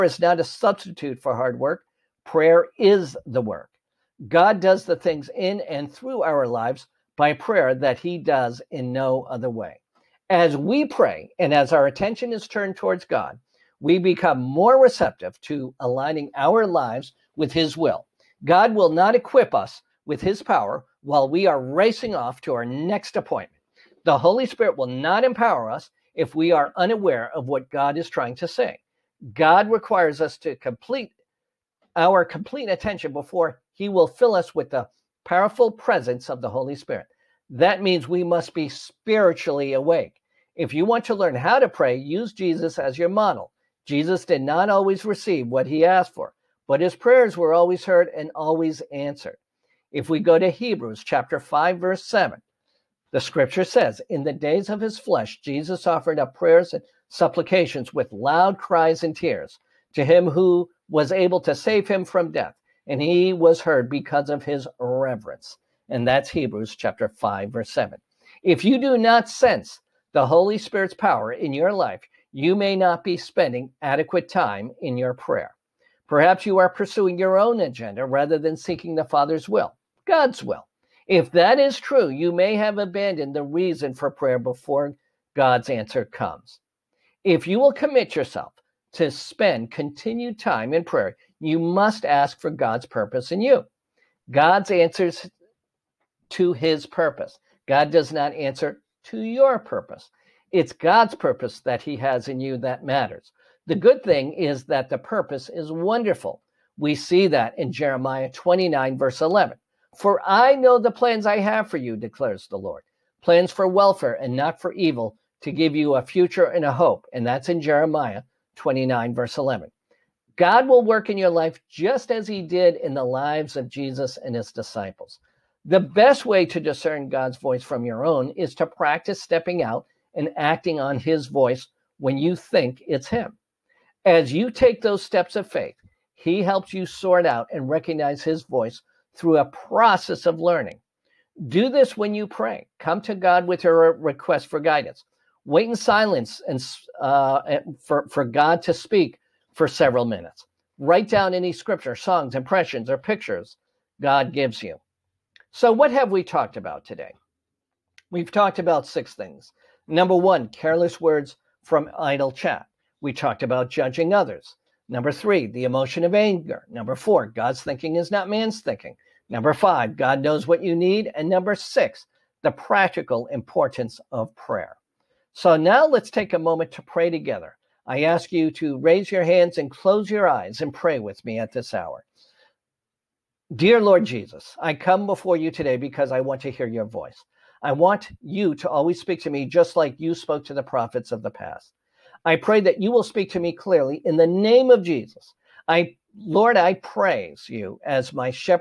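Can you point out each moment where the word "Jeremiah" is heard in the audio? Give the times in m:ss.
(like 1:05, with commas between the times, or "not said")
1:47, 1:57.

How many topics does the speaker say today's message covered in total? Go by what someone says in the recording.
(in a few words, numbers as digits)
6.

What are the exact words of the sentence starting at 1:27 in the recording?
If you will commit yourself to spend continued time in prayer, you must ask for God's purpose in you.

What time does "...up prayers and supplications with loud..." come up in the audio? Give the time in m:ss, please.
0:56.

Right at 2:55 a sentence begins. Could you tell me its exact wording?
So now let's take a moment to pray together.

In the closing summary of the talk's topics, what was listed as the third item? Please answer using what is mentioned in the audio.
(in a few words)
Anger.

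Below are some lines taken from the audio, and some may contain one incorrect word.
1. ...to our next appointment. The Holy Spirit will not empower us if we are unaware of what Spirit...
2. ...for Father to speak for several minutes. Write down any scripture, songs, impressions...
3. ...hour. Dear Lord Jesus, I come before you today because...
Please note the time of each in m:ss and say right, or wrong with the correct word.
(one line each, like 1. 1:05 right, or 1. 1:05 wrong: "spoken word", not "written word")
1. 0:22 wrong: "God", not "Spirit"
2. 2:28 wrong: "God", not "Father"
3. 3:01 right.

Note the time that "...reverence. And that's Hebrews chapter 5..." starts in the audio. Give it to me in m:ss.
1:04.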